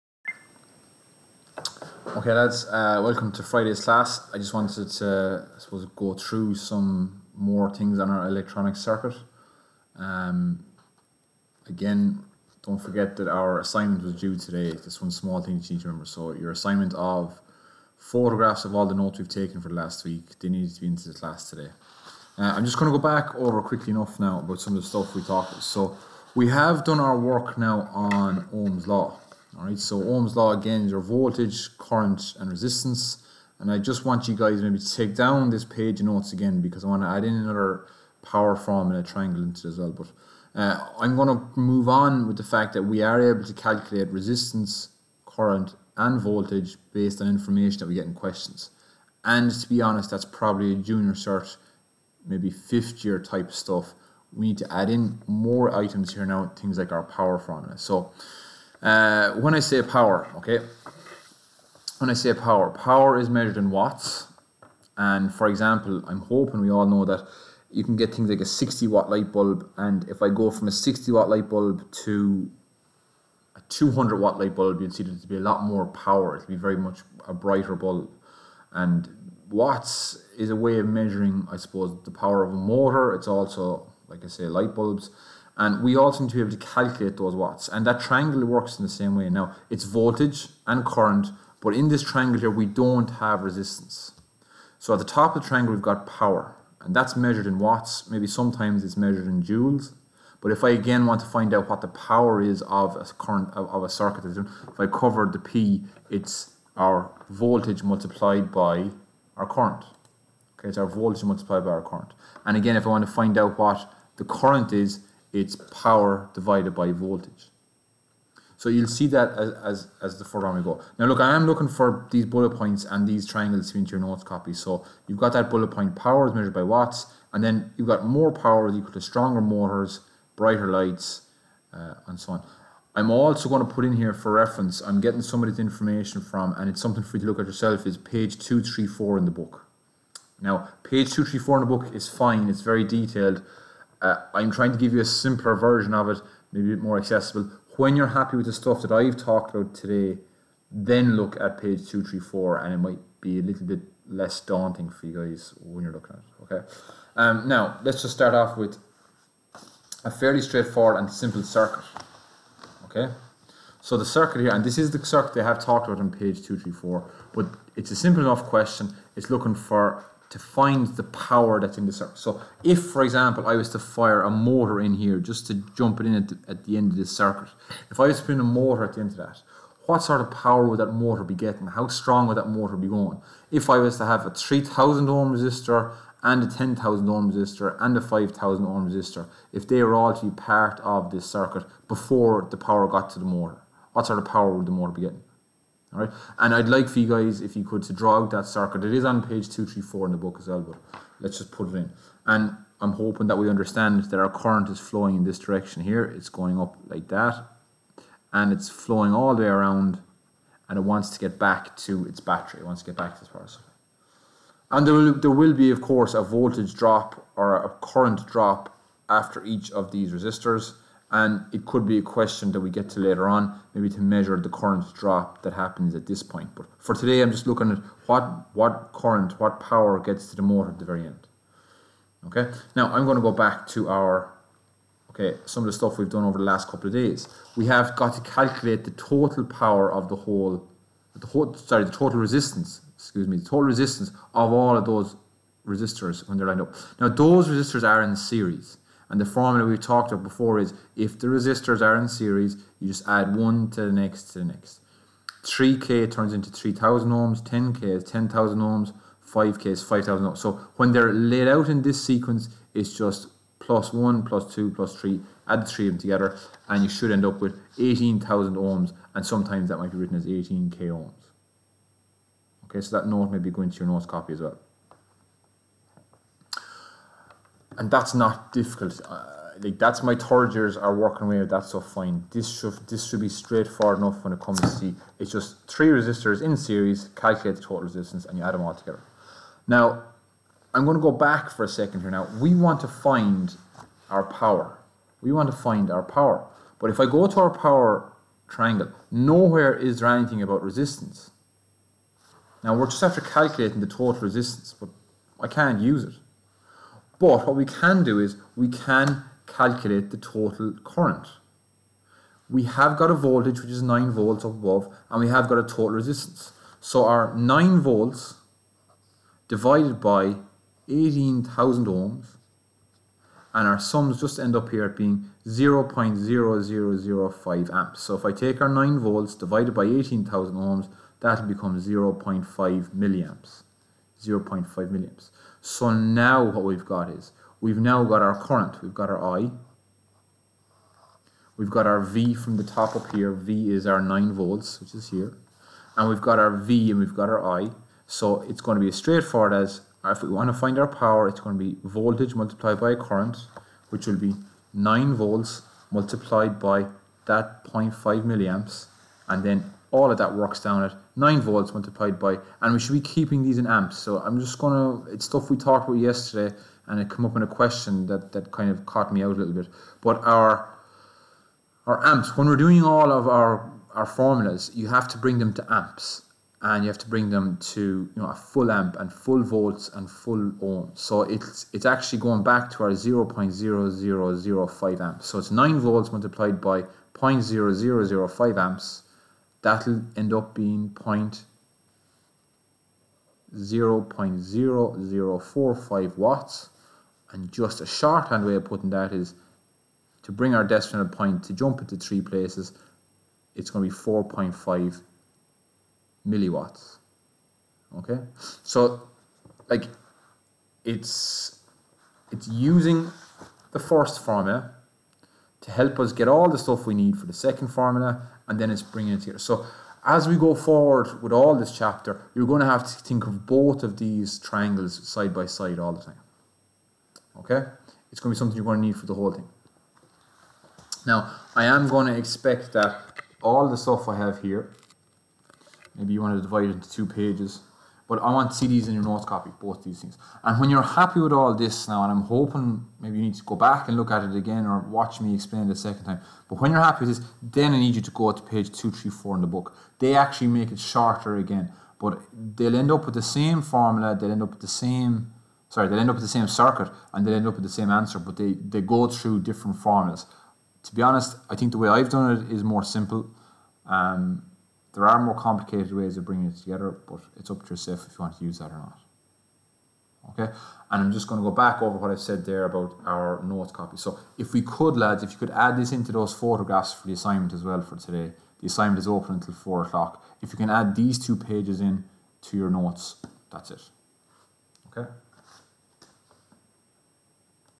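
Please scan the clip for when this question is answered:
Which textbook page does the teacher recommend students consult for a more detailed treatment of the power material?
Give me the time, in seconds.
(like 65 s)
137 s.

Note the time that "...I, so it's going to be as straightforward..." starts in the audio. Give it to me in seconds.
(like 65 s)
347 s.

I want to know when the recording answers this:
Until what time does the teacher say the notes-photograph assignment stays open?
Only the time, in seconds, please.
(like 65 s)
479 s.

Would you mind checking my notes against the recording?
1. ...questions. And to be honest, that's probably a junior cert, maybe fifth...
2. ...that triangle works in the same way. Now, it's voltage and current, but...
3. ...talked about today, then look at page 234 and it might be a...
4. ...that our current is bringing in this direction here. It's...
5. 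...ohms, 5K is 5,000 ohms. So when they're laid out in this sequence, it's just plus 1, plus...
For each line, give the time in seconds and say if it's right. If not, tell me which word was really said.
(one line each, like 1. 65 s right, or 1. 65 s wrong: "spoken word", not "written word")
1. 48 s right
2. 87 s right
3. 149 s right
4. 204 s wrong: "flowing", not "bringing"
5. 258 s right.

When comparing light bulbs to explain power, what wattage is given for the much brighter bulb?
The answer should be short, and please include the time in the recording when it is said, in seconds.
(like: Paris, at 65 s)
200 watt, at 73 s.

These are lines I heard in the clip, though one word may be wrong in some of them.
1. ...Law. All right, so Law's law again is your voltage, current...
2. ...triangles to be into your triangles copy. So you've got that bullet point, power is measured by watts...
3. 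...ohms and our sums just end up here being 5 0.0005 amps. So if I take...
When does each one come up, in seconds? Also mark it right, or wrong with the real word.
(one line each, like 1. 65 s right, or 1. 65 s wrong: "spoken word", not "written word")
1. 28 s wrong: "Ohm", not "Law"
2. 123 s wrong: "notes", not "triangles"
3. 321 s wrong: "0", not "5".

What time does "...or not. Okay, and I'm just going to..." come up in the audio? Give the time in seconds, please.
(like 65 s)
468 s.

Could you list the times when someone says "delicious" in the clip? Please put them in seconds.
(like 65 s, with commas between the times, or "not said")
not said.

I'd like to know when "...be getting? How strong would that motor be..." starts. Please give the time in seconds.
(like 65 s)
181 s.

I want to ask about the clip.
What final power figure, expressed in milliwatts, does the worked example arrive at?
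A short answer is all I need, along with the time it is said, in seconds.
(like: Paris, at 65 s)
4.5 milliwatts, at 404 s.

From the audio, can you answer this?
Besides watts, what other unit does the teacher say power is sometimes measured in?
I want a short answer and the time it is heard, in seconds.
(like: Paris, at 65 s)
joules, at 99 s.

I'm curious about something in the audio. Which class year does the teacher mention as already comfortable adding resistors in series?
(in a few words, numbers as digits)
third years.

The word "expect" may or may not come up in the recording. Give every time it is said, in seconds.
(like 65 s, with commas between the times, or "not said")
432 s.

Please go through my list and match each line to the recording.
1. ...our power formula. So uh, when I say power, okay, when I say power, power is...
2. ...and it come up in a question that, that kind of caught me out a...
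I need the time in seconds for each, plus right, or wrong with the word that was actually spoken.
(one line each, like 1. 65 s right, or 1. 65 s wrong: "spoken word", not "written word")
1. 56 s right
2. 366 s right.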